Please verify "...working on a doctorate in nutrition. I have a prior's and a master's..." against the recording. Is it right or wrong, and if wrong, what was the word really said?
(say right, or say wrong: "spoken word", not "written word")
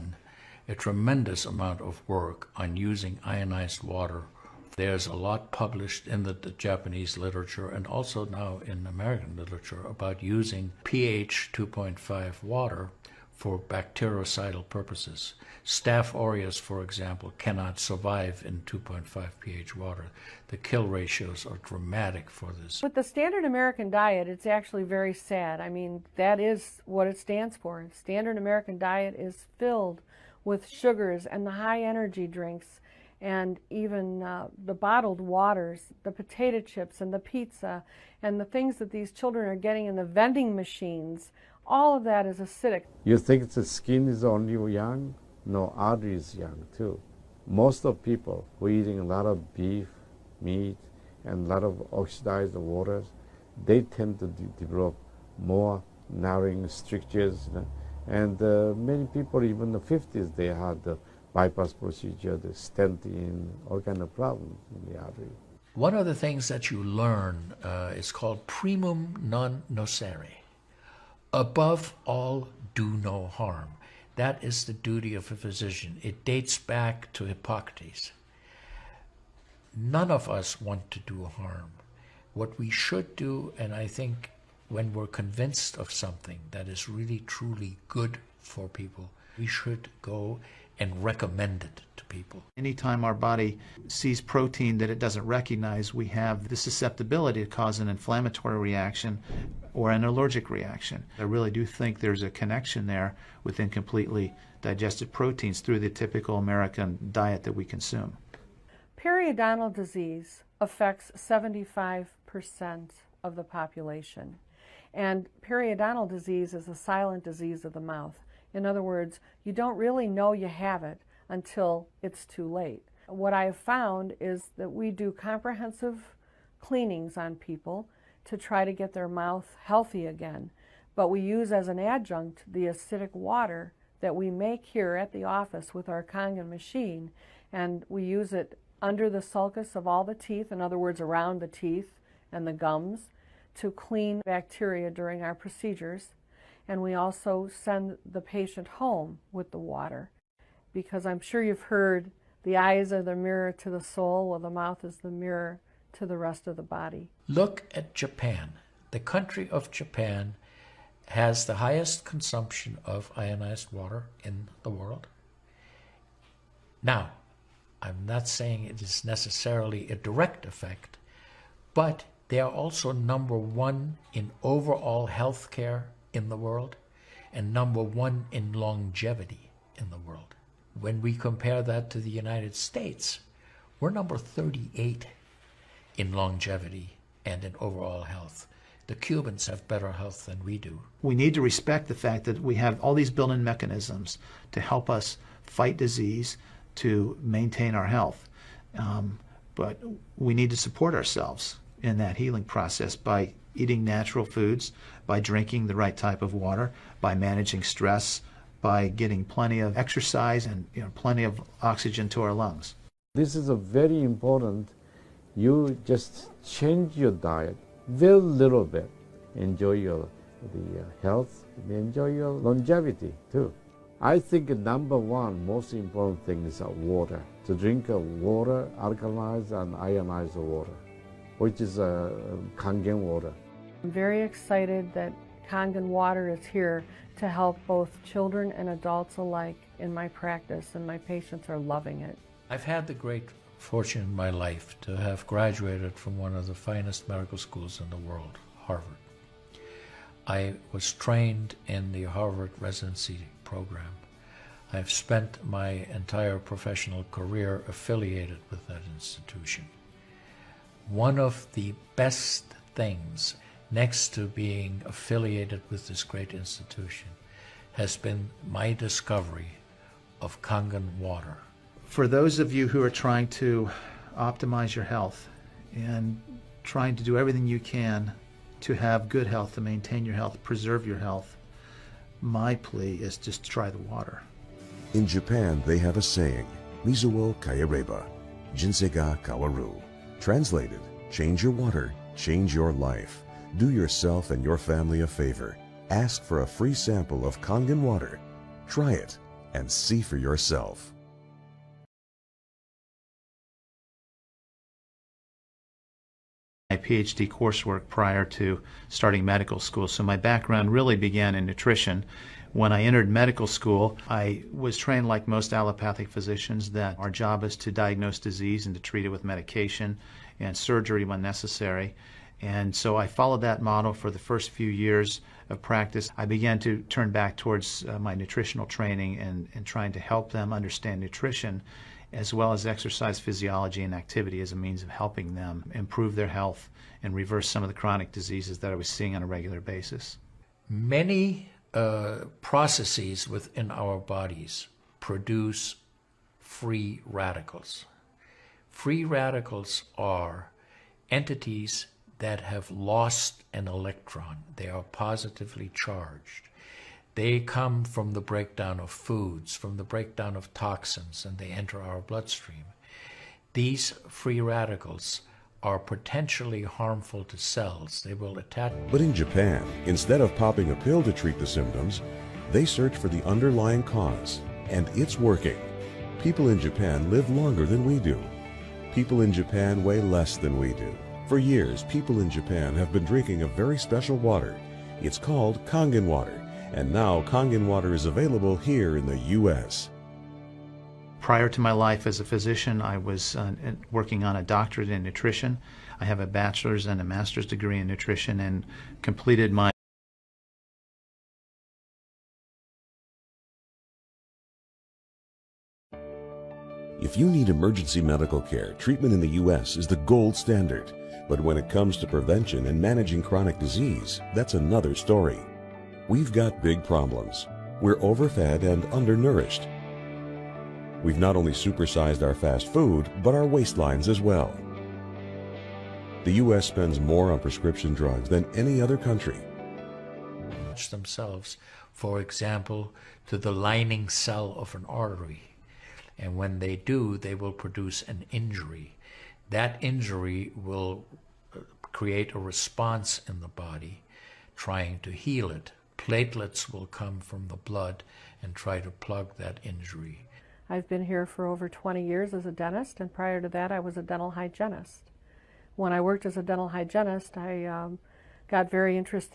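wrong: "bachelor", not "prior".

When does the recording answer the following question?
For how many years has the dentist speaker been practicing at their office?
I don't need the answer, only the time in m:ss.
7:31.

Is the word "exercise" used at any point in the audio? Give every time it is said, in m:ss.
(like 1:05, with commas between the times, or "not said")
3:29, 5:32.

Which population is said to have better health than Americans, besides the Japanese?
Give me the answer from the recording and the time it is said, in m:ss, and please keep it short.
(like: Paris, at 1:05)
The Cubans, at 3:08.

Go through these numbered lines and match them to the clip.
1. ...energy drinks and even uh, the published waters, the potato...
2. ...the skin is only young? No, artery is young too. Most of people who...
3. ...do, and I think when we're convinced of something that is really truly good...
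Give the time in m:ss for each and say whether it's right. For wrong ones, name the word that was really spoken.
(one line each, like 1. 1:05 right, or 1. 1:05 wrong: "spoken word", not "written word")
1. 0:31 wrong: "bottled", not "published"
2. 0:43 right
3. 1:23 right.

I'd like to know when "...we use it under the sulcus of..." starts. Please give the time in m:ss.
2:17.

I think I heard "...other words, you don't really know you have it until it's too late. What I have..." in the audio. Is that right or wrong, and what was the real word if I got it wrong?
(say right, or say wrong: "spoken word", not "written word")
right.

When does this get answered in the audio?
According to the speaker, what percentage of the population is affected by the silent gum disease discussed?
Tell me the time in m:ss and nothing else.
1:51.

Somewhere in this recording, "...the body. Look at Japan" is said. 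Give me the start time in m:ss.
2:36.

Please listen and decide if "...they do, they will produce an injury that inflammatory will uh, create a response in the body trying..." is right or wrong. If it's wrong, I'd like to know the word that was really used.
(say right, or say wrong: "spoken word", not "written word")
wrong: "injury", not "inflammatory".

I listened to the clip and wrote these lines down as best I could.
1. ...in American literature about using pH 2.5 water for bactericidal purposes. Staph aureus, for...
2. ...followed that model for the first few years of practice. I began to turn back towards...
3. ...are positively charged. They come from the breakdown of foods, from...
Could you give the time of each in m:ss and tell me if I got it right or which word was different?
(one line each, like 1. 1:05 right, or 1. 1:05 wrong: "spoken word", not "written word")
1. 0:08 right
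2. 5:23 right
3. 5:54 right.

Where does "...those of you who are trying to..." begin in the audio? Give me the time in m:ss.
4:32.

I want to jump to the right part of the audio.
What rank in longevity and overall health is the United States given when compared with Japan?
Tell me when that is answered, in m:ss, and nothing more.
3:03.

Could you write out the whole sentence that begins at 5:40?
Many uh, processes within our bodies produce free radicals.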